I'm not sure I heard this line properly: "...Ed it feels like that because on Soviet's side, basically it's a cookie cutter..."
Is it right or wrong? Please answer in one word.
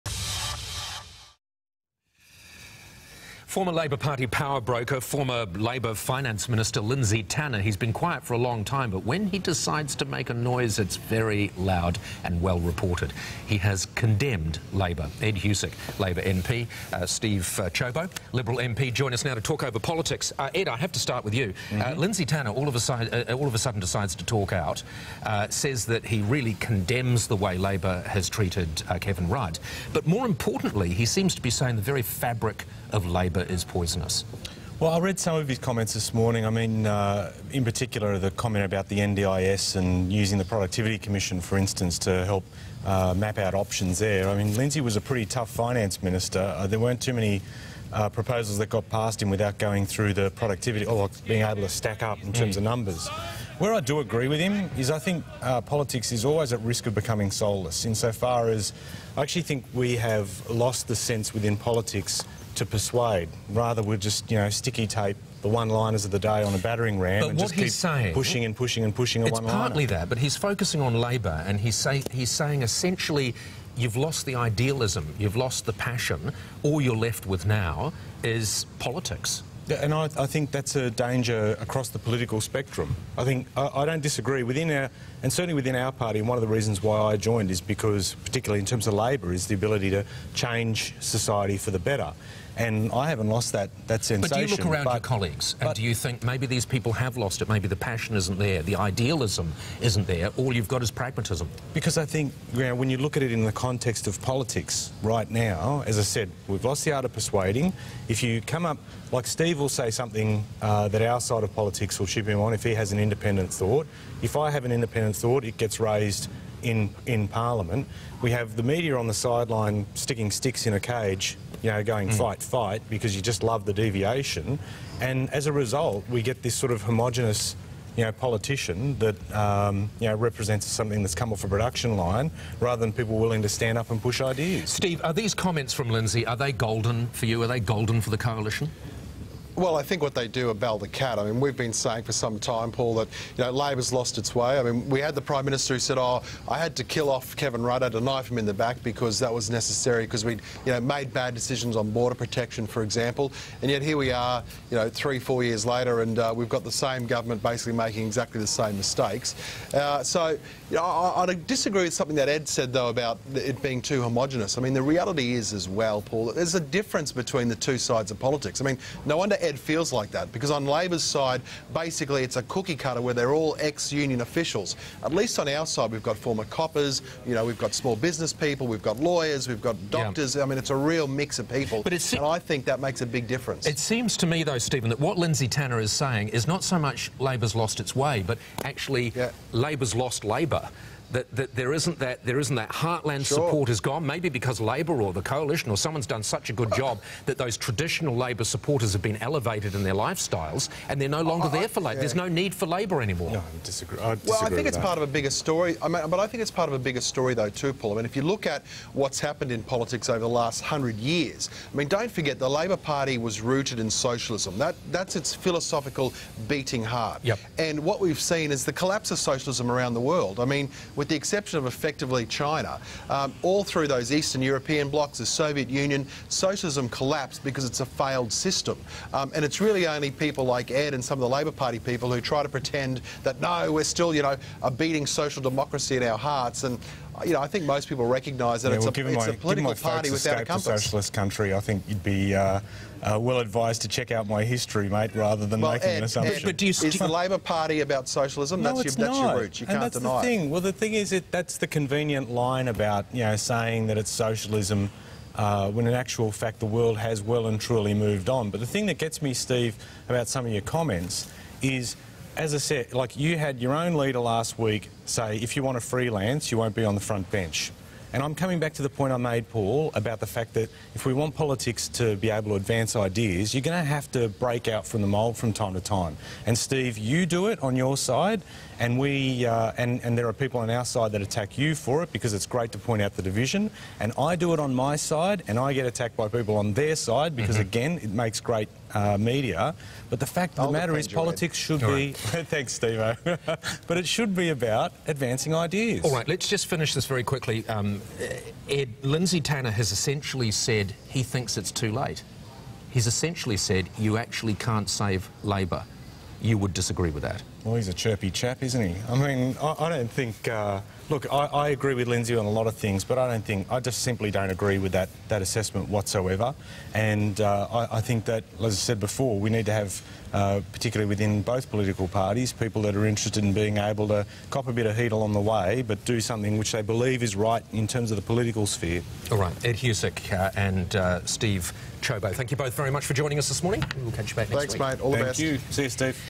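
wrong.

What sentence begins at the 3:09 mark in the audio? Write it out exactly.
Labor's lost Labor that, that there isn't that there isn't that heartland sure.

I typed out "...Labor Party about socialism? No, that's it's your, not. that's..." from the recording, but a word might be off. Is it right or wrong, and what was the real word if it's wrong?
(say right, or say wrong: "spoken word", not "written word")
right.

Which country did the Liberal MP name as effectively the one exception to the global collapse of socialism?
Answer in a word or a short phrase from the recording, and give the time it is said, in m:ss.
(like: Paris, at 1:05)
China, at 3:42.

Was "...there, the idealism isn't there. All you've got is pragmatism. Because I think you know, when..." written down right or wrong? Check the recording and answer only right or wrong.
right.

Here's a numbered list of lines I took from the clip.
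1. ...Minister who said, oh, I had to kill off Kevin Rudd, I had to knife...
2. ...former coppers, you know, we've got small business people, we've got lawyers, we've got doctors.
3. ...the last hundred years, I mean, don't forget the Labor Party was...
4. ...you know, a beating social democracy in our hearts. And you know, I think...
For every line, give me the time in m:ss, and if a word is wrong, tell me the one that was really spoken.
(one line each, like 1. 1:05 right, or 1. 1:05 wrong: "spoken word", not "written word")
1. 2:25 right
2. 2:56 right
3. 3:30 right
4. 3:54 right.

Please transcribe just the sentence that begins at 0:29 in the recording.
But more importantly, he seems to be saying the very fabric of Labor is poisonous?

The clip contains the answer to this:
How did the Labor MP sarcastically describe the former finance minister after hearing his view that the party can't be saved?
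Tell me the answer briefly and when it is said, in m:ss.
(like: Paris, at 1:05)
a chirpy chap, at 5:07.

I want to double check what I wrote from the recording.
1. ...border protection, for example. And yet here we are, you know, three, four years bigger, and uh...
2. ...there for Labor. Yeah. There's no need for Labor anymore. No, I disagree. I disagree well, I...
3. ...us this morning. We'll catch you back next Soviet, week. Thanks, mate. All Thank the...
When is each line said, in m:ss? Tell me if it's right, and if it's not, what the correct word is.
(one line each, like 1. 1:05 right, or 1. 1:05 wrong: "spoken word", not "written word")
1. 2:31 wrong: "later", not "bigger"
2. 3:21 right
3. 5:33 wrong: "Thanks", not "Soviet".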